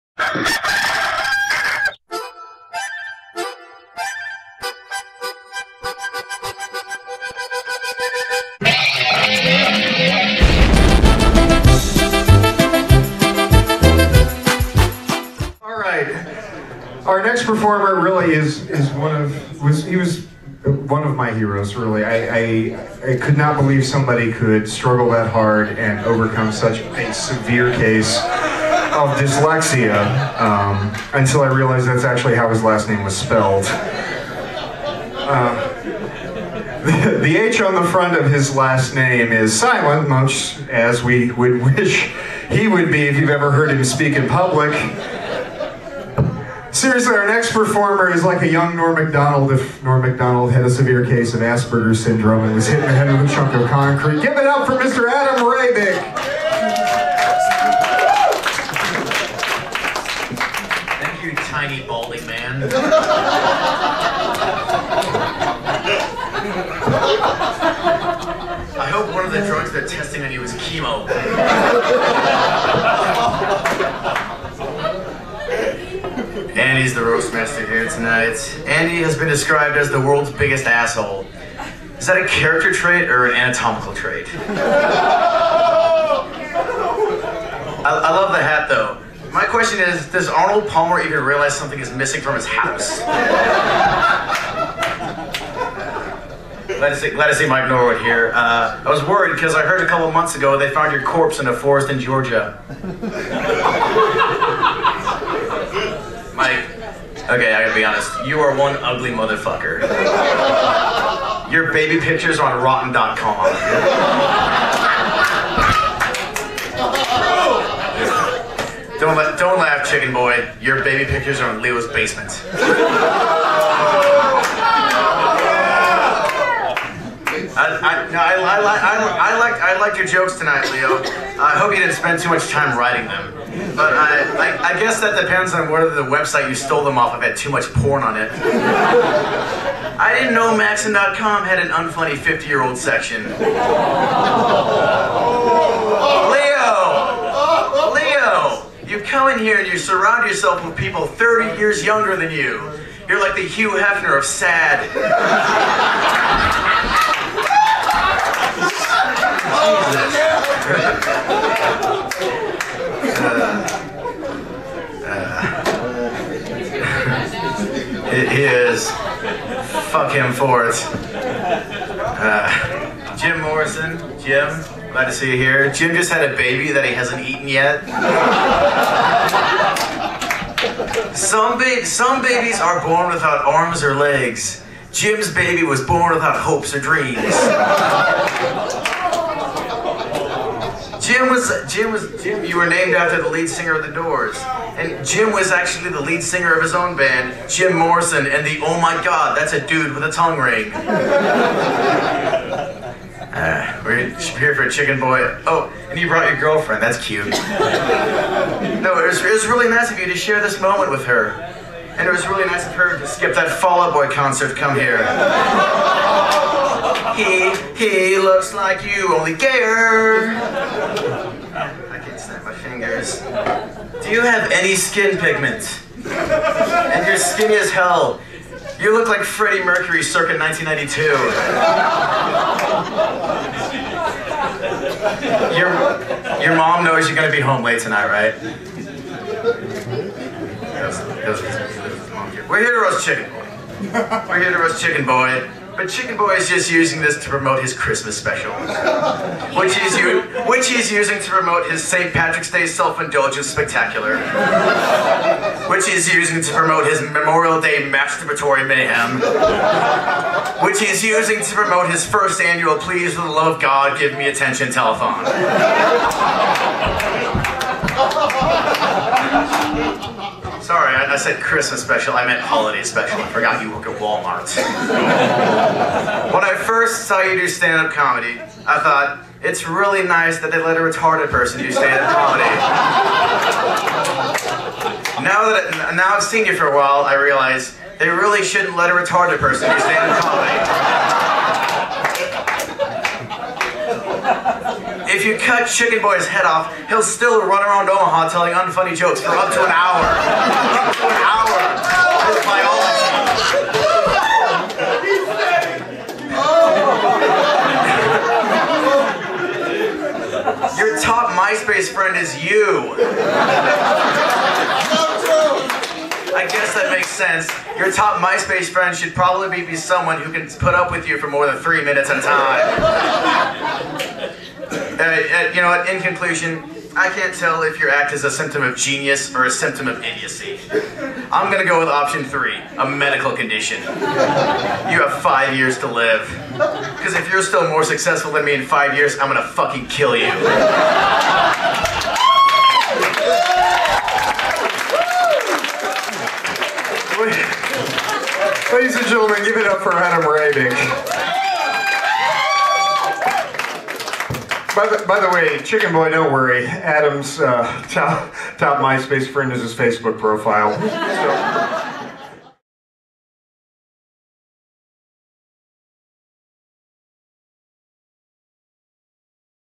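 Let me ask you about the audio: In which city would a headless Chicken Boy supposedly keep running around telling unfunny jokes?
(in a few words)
Omaha.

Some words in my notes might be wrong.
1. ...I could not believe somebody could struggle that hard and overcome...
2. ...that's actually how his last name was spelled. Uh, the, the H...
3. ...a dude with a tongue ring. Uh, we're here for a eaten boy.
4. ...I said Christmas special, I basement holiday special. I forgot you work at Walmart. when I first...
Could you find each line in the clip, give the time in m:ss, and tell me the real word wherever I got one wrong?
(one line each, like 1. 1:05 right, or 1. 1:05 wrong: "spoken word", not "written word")
1. 0:23 right
2. 0:31 right
3. 3:19 wrong: "chicken", not "eaten"
4. 4:30 wrong: "meant", not "basement".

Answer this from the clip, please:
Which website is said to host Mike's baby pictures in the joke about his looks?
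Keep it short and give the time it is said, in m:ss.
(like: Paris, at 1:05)
rotten.com, at 1:52.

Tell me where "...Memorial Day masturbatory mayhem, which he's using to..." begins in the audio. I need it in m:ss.
4:17.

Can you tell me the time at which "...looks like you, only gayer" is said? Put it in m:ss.
3:38.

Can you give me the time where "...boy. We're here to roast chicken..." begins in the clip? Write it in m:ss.
4:03.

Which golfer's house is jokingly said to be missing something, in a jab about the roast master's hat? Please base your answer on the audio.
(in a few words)
Arnold Palmer.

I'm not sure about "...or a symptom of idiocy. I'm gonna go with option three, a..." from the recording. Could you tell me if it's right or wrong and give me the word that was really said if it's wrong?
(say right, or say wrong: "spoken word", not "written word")
right.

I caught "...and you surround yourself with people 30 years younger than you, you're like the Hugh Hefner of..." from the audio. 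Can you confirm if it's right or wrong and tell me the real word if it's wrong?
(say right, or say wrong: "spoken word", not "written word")
right.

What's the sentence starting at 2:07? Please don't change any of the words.
I, no, I, I, liked, I liked your jokes tonight, Leo.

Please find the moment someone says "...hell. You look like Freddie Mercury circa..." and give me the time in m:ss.
3:47.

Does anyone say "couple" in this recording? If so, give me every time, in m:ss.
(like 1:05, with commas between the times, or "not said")
1:39.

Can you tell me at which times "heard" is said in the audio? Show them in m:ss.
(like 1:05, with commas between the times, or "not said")
0:43, 1:39.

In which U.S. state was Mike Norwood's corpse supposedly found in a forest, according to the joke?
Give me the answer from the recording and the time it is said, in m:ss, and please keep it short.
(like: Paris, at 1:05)
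Georgia, at 1:41.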